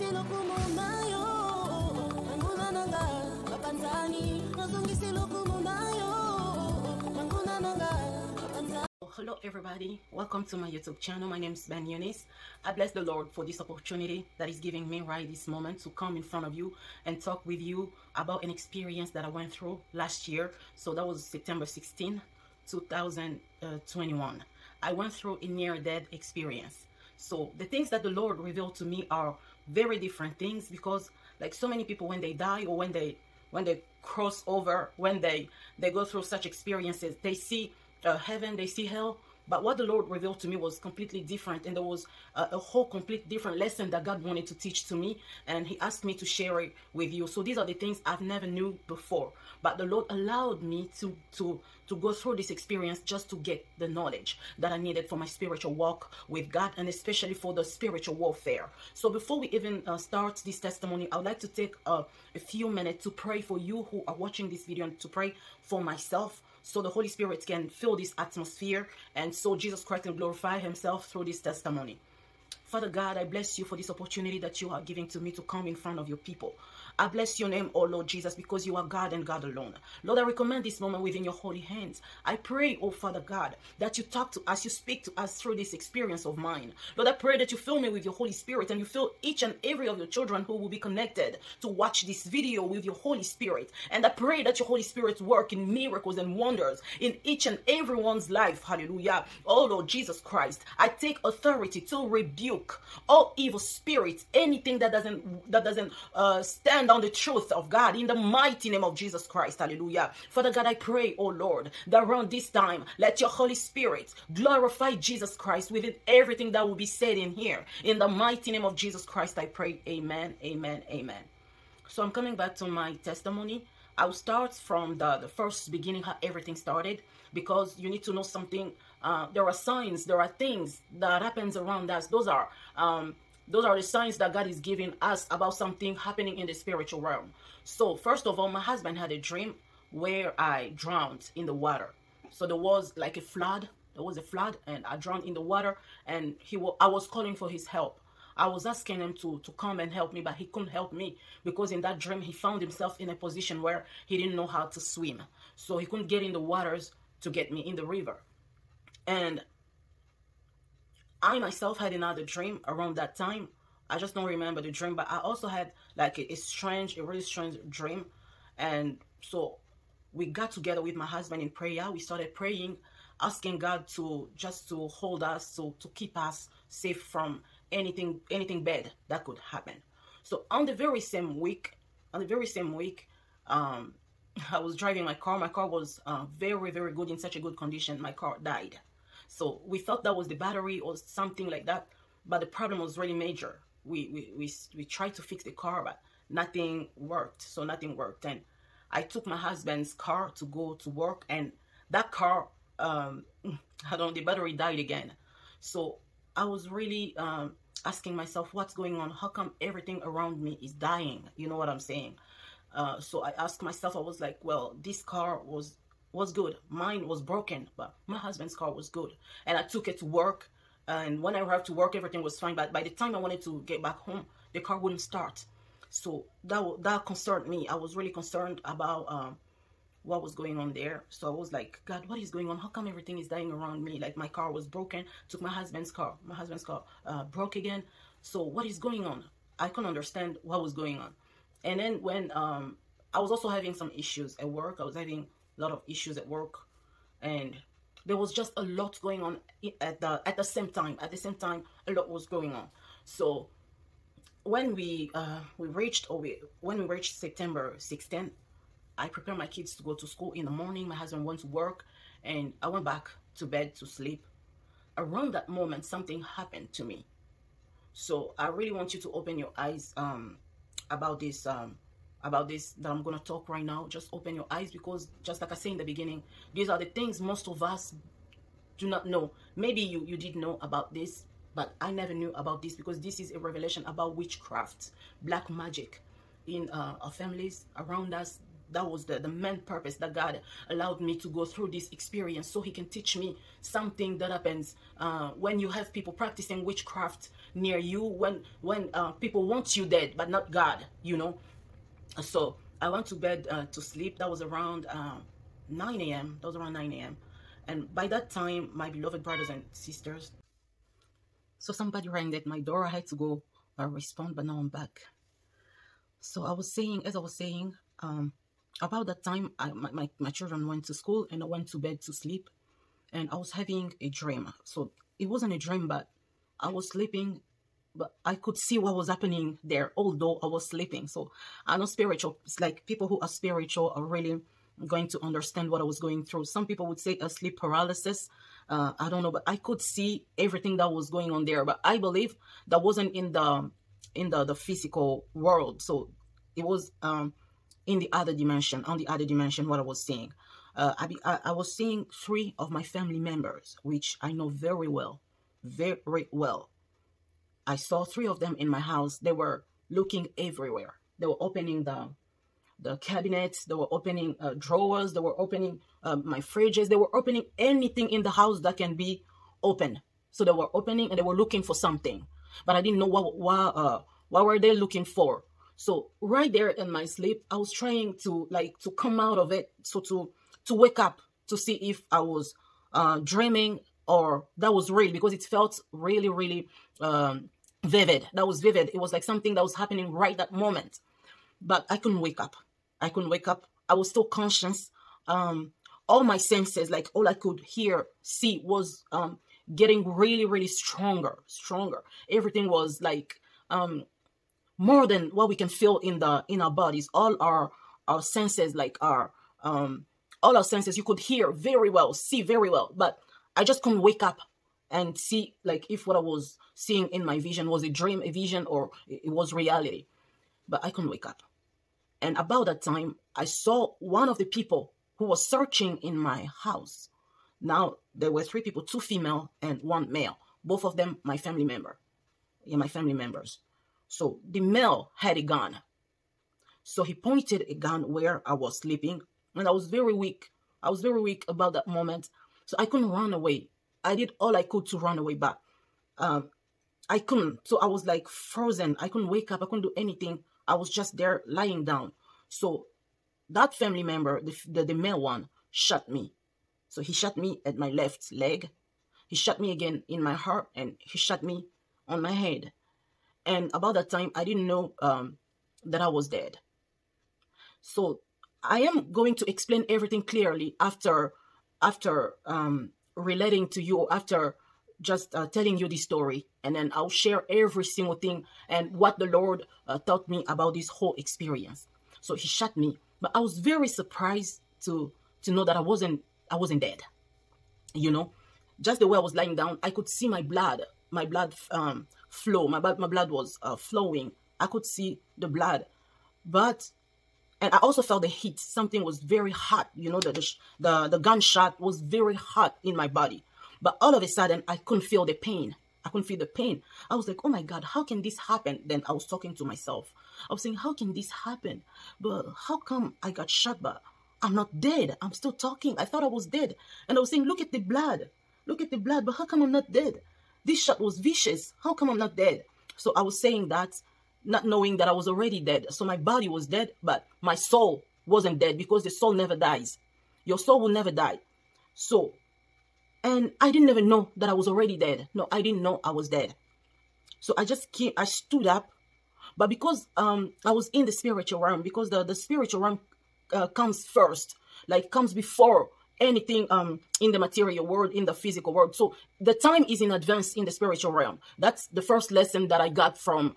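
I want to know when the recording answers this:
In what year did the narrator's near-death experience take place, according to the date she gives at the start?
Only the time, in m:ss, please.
0:22.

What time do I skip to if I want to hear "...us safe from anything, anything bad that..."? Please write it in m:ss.
2:56.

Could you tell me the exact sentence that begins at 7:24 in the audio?
I did all I could to run away back.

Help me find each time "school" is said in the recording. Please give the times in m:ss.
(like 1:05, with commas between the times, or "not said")
4:20, 5:20.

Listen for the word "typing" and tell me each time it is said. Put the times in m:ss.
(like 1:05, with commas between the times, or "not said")
not said.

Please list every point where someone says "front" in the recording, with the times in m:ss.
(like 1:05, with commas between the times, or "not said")
0:16, 1:15.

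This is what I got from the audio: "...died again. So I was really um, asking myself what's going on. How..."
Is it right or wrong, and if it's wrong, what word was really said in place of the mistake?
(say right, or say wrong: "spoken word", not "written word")
right.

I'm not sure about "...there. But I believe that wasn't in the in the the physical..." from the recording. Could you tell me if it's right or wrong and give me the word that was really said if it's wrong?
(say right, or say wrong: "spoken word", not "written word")
right.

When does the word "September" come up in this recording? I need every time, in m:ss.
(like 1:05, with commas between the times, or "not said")
0:21, 4:17.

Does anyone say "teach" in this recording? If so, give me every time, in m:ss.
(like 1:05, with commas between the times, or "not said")
0:44, 4:52.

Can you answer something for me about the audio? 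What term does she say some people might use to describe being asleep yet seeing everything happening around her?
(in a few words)
sleep paralysis.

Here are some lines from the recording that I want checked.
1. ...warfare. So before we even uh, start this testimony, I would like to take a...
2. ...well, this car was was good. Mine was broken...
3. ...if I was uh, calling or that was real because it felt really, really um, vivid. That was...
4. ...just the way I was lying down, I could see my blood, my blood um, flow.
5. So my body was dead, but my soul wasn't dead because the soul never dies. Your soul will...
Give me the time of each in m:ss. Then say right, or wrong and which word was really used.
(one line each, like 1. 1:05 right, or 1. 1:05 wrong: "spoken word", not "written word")
1. 0:58 right
2. 3:34 right
3. 6:21 wrong: "dreaming", not "calling"
4. 8:08 right
5. 8:45 right.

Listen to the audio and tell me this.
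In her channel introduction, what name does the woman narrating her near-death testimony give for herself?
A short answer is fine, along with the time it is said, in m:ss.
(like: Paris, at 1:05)
Ben Eunyce, at 0:11.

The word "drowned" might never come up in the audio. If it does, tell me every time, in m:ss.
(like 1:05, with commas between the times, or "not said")
2:20, 2:24.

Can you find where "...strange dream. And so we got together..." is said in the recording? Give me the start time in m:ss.
2:47.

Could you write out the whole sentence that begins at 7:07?
Now, there were three people, two female and one male.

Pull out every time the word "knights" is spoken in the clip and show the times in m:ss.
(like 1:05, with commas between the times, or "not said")
not said.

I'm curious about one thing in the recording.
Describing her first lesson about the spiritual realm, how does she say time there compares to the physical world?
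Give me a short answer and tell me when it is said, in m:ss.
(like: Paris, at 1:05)
in advance, at 9:10.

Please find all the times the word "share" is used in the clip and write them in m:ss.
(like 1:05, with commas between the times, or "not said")
0:46, 7:57.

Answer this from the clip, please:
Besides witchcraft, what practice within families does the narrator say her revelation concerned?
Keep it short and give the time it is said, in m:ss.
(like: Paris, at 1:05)
black magic, at 4:45.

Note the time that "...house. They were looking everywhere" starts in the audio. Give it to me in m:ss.
5:58.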